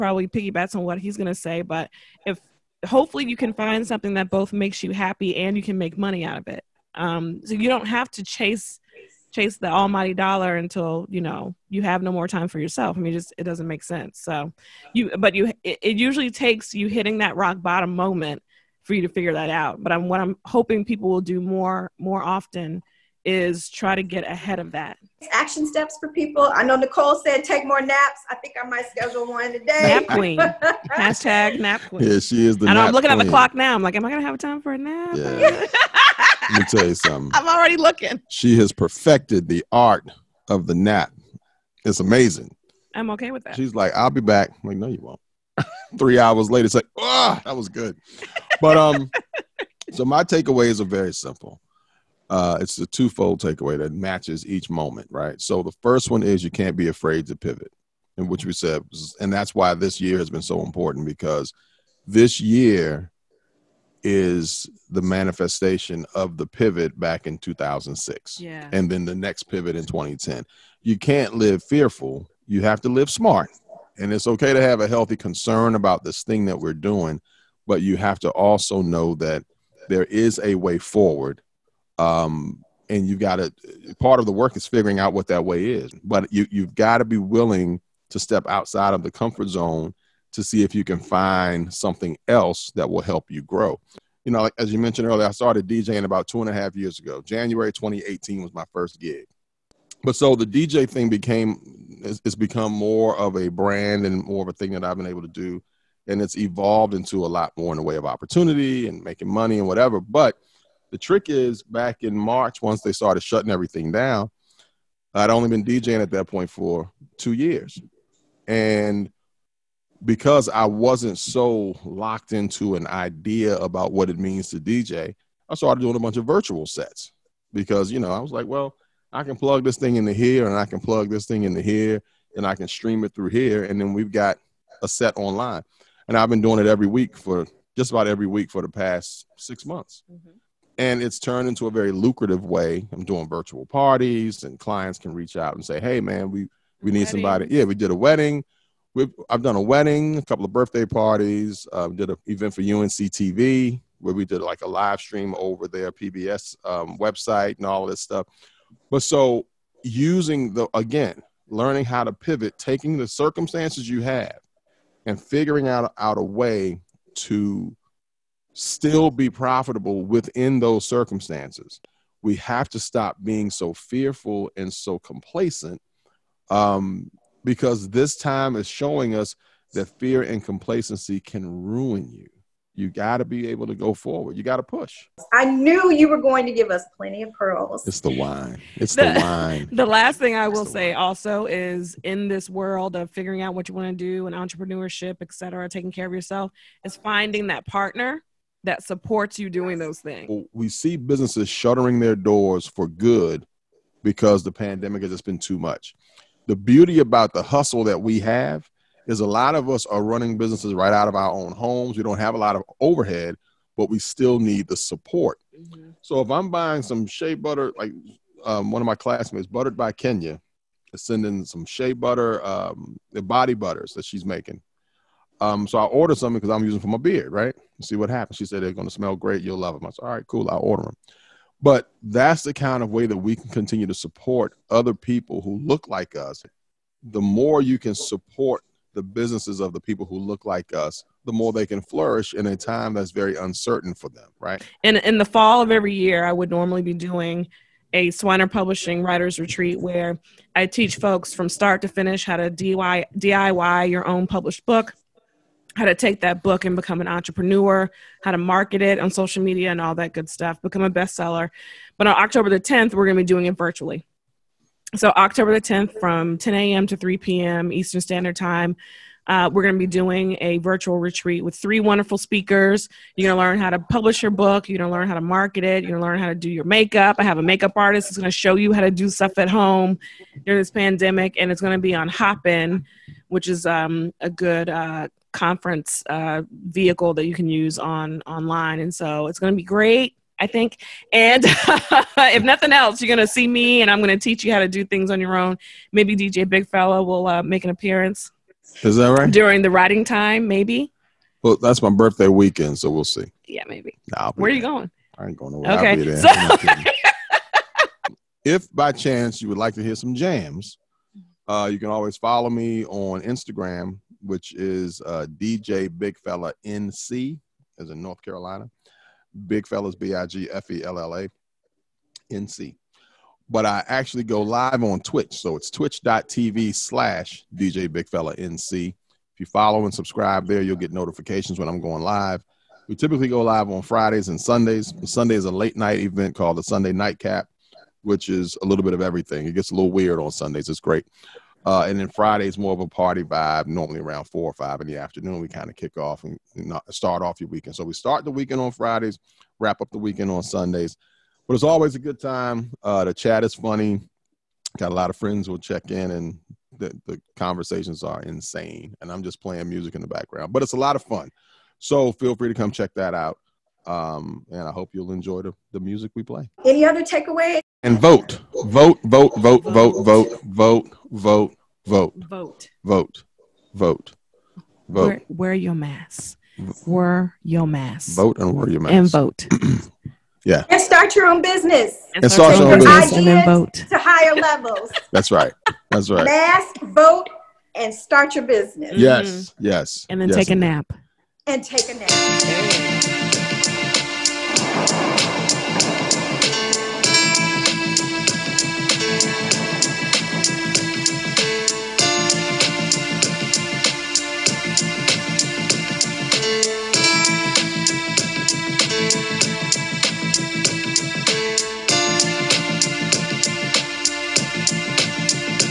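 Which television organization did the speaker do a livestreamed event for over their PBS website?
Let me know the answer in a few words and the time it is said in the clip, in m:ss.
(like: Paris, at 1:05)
UNC TV, at 2:32.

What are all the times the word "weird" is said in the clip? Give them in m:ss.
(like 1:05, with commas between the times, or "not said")
5:39.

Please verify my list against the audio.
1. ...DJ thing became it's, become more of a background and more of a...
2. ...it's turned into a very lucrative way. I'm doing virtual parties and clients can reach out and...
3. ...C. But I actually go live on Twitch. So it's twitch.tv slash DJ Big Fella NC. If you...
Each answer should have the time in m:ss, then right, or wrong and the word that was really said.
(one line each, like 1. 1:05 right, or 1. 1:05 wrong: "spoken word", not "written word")
1. 1:40 wrong: "brand", not "background"
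2. 2:21 right
3. 5:22 right.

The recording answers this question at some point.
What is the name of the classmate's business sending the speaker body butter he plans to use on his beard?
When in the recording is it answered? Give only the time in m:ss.
3:39.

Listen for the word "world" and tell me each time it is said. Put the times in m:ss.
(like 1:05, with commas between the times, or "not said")
3:12.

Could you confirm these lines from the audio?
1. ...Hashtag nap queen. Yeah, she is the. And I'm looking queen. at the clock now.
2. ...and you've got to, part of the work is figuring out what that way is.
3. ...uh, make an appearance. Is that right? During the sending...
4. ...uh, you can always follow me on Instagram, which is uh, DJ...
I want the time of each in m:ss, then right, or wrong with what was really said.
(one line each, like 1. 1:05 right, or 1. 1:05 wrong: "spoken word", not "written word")
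1. 0:30 right
2. 1:22 right
3. 4:57 wrong: "writing", not "sending"
4. 5:11 right.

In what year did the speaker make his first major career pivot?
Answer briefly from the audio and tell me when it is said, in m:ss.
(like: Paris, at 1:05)
2006, at 1:07.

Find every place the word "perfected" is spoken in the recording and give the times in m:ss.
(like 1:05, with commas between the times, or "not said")
0:38.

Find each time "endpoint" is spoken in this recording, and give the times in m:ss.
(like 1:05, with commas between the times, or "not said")
not said.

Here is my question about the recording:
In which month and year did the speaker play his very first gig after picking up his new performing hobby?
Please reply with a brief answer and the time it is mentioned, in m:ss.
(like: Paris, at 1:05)
January 2018, at 1:37.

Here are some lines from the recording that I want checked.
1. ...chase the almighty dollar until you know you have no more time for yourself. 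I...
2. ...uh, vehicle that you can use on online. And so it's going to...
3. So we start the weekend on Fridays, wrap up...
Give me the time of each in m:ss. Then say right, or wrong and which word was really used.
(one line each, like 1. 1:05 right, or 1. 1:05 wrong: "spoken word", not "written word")
1. 0:09 right
2. 4:46 right
3. 5:47 right.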